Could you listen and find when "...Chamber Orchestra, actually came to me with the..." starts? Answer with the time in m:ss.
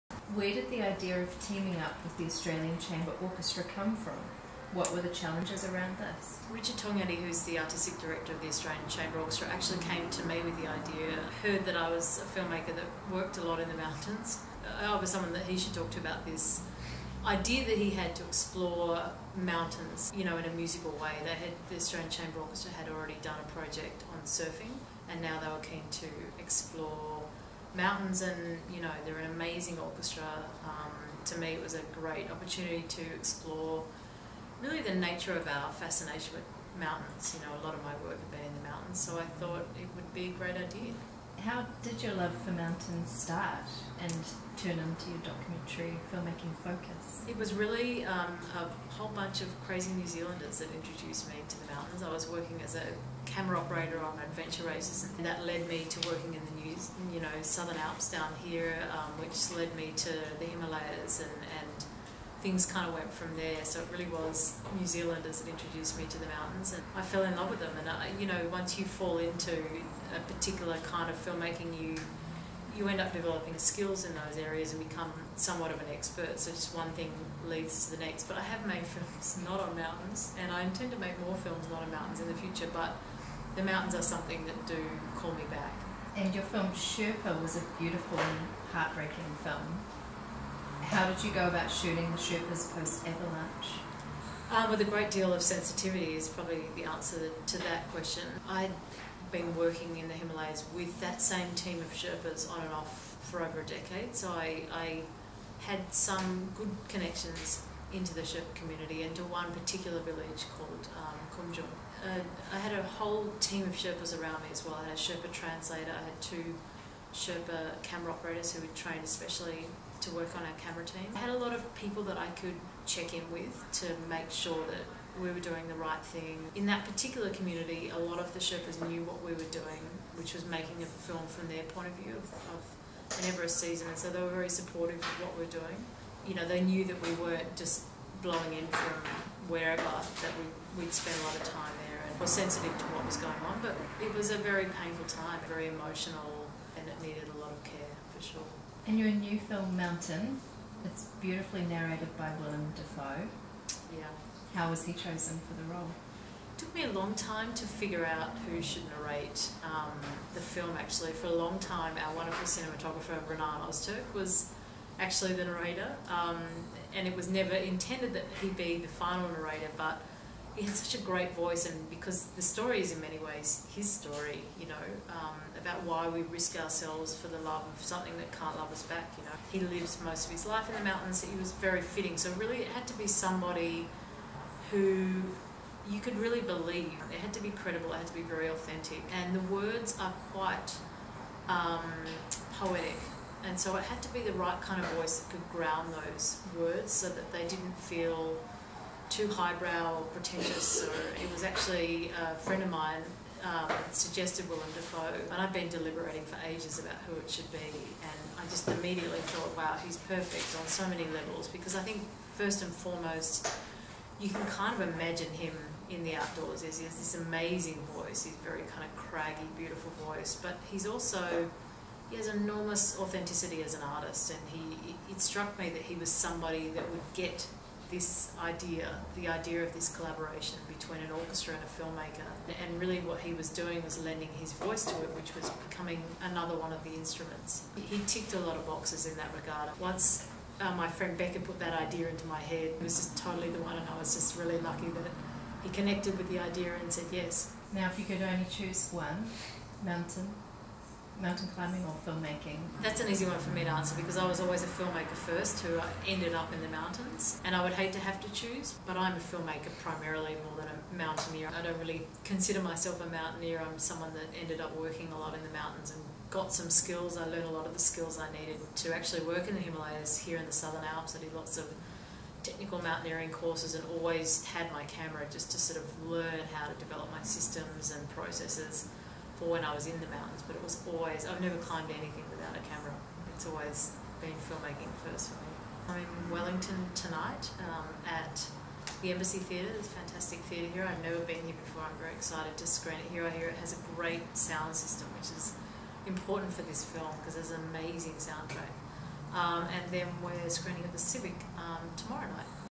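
0:08.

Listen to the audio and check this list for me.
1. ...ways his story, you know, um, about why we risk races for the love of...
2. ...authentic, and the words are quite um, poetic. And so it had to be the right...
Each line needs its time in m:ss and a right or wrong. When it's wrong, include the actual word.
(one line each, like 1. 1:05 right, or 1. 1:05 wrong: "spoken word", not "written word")
1. 2:53 wrong: "ourselves", not "races"
2. 3:08 right.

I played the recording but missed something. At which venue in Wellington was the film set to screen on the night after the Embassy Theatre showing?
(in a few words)
The Civic.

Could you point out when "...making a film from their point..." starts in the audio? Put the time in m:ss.
2:10.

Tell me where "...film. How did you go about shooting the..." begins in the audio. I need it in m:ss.
1:29.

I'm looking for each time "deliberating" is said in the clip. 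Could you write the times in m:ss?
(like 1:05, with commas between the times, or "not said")
3:25.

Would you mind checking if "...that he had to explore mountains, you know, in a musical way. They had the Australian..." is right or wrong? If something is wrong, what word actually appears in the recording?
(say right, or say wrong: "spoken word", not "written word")
right.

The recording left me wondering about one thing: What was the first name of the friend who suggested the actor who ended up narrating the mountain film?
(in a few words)
Becca.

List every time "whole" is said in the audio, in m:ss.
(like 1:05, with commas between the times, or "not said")
0:48, 1:52.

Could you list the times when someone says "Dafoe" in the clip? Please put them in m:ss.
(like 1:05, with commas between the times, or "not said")
2:32, 3:24.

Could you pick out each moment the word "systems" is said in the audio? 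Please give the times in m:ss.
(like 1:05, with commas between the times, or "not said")
4:37, 4:54.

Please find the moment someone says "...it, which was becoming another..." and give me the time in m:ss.
3:55.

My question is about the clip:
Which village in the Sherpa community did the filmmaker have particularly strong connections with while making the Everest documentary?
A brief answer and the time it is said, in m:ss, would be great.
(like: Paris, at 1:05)
Kumjung, at 1:51.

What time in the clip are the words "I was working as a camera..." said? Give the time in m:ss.
0:52.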